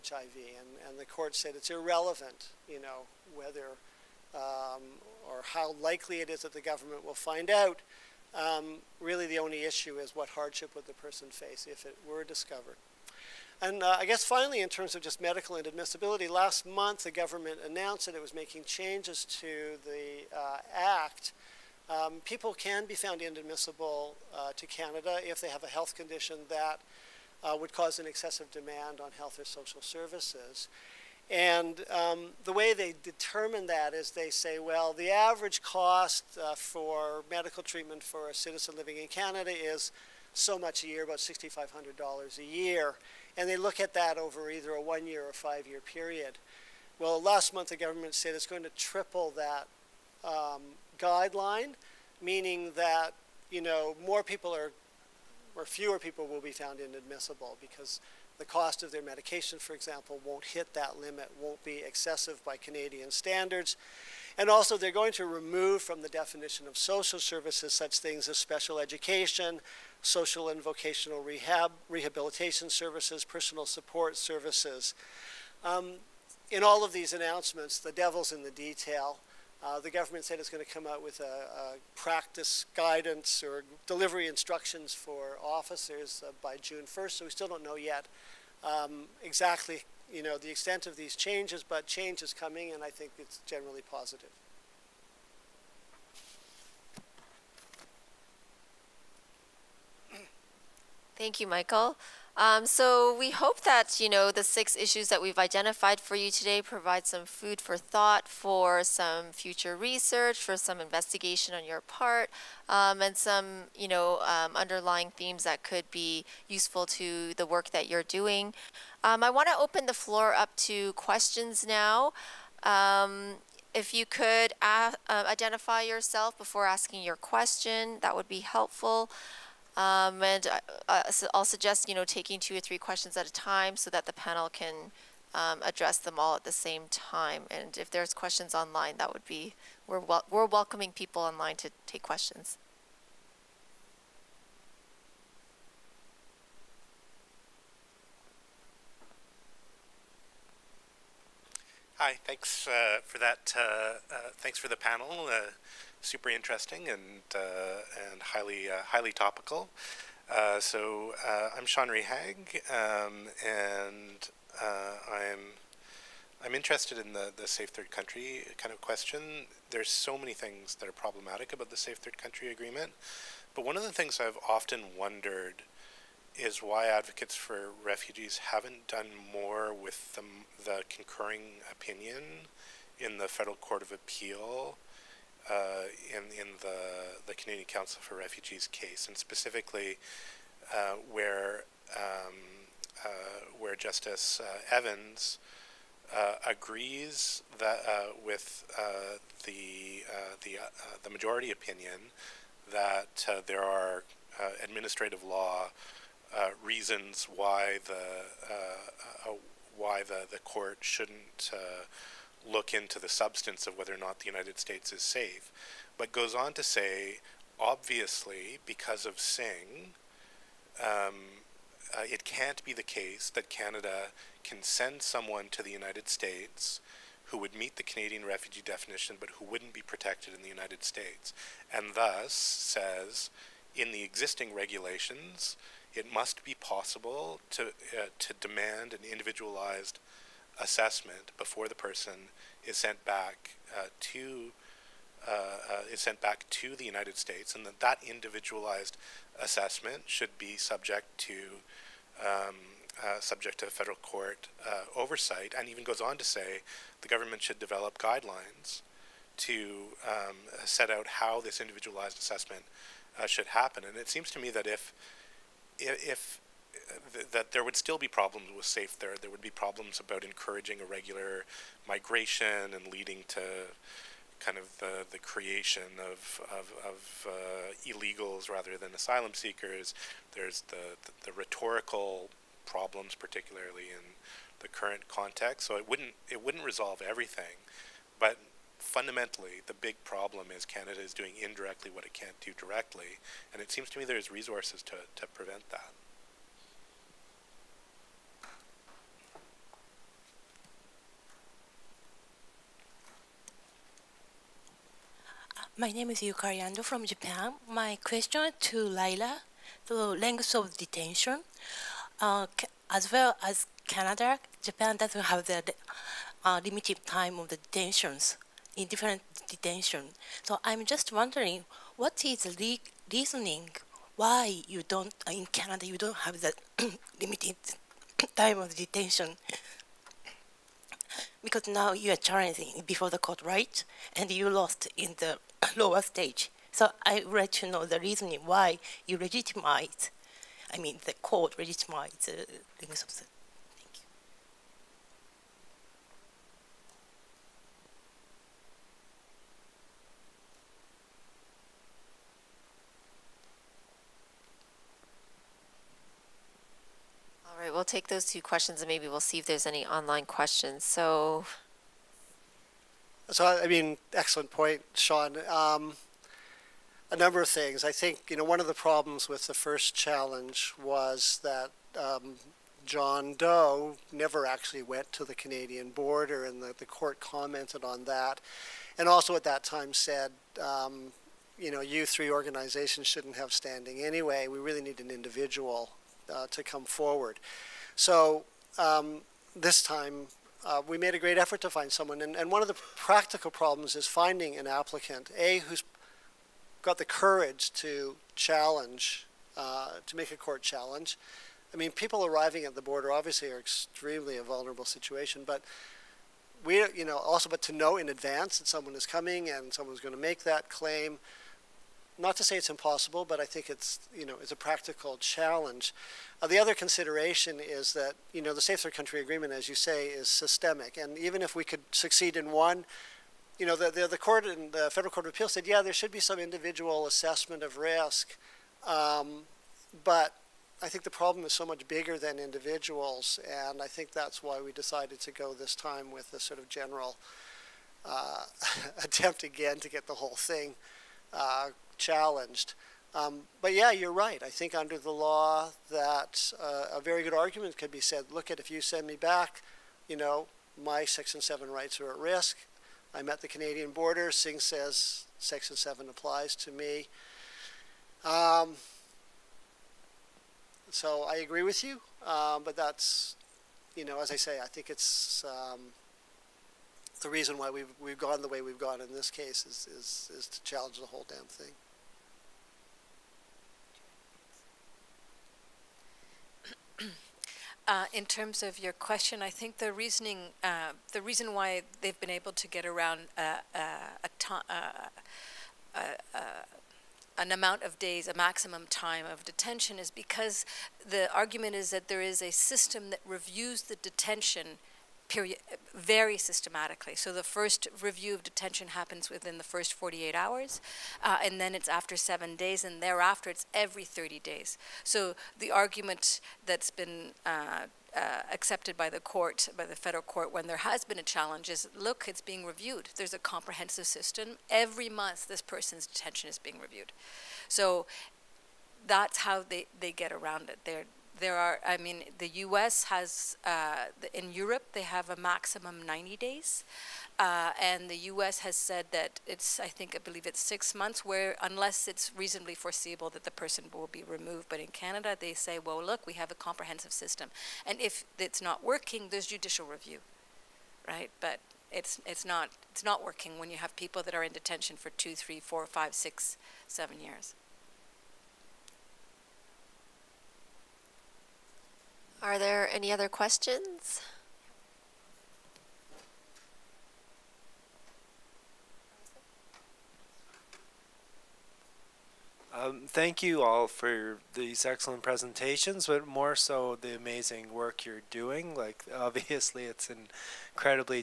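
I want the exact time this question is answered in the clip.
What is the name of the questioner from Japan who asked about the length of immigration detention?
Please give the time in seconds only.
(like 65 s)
306 s.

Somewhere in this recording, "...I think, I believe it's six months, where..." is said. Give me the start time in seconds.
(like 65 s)
529 s.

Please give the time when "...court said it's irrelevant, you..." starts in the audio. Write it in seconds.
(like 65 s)
1 s.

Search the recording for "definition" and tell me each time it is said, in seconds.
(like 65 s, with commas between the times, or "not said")
66 s, 228 s.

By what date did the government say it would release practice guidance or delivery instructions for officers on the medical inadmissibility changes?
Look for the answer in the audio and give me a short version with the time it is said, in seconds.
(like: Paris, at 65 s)
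June 1st, at 86 s.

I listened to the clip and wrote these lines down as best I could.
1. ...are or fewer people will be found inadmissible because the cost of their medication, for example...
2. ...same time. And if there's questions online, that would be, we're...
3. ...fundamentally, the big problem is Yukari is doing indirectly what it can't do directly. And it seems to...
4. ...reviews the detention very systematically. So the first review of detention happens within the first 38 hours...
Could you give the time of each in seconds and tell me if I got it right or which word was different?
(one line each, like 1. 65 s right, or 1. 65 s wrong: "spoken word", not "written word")
1. 54 s right
2. 136 s right
3. 288 s wrong: "Canada", not "Yukari"
4. 493 s wrong: "48", not "38".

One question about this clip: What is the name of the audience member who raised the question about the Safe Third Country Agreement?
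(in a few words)
Sean Rehaag.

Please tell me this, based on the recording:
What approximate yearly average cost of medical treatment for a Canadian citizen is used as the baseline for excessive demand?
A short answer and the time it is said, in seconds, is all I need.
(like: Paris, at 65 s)
$6,500, at 41 s.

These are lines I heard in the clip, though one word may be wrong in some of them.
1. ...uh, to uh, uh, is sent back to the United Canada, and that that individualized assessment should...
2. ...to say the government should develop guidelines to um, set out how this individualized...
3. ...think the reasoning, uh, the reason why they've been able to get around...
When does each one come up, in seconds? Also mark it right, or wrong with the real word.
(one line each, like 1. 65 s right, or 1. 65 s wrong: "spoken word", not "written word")
1. 243 s wrong: "States", not "Canada"
2. 256 s right
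3. 479 s right.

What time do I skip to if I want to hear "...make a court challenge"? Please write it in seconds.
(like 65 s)
400 s.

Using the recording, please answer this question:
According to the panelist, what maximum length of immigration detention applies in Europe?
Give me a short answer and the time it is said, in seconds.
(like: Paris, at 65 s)
90 days, at 526 s.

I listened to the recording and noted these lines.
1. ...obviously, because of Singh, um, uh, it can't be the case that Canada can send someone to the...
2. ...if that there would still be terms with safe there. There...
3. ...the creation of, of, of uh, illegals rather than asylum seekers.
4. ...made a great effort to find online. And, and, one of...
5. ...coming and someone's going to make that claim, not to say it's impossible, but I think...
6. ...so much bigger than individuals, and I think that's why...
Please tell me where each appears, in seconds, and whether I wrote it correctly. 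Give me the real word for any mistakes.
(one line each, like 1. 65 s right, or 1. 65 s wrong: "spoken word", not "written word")
1. 217 s right
2. 265 s wrong: "problems", not "terms"
3. 275 s right
4. 390 s wrong: "someone", not "online"
5. 409 s right
6. 431 s right.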